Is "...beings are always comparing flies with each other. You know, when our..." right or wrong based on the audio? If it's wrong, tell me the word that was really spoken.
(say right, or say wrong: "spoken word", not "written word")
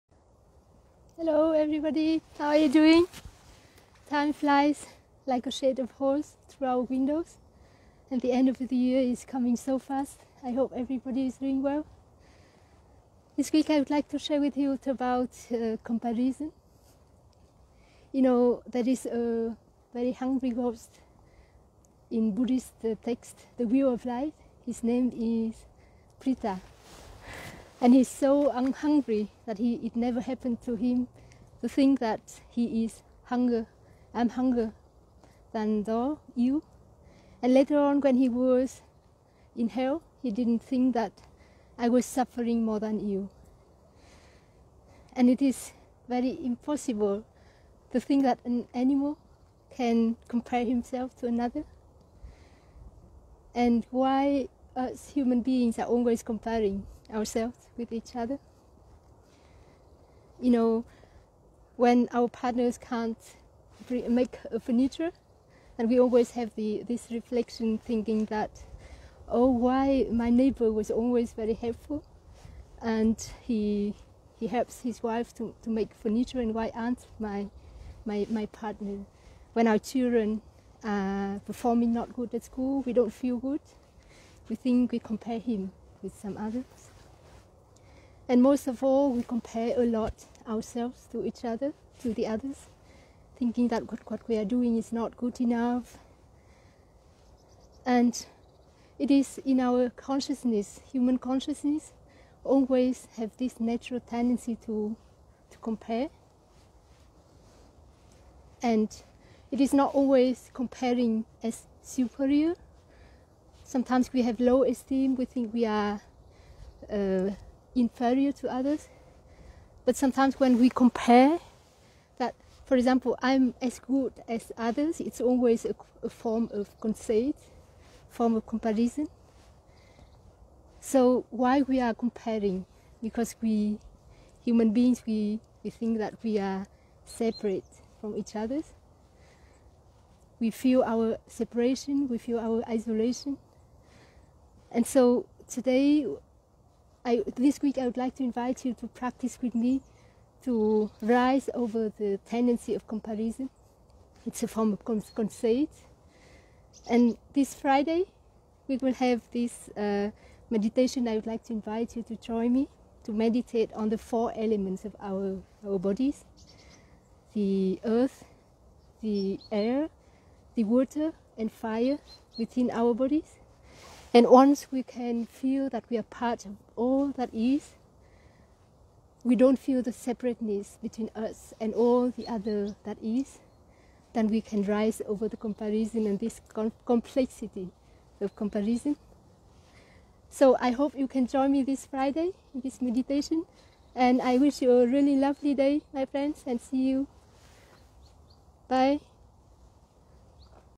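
wrong: "ourselves", not "flies".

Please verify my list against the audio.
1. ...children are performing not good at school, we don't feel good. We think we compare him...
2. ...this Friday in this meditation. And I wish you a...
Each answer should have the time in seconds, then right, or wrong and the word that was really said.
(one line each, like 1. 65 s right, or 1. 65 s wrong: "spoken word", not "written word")
1. 79 s right
2. 191 s right.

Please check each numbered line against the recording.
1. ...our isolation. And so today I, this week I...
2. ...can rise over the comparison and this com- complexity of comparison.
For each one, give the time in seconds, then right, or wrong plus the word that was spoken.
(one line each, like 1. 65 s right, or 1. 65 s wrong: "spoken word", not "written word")
1. 142 s right
2. 184 s right.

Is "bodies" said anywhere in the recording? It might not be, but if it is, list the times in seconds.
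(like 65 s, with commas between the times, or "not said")
165 s, 172 s.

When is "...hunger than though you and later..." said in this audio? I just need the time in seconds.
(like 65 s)
34 s.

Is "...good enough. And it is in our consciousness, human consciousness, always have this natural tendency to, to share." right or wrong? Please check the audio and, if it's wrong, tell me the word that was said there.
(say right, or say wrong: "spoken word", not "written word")
wrong: "compare", not "share".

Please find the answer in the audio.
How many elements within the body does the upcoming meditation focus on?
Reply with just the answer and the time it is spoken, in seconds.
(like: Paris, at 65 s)
4, at 163 s.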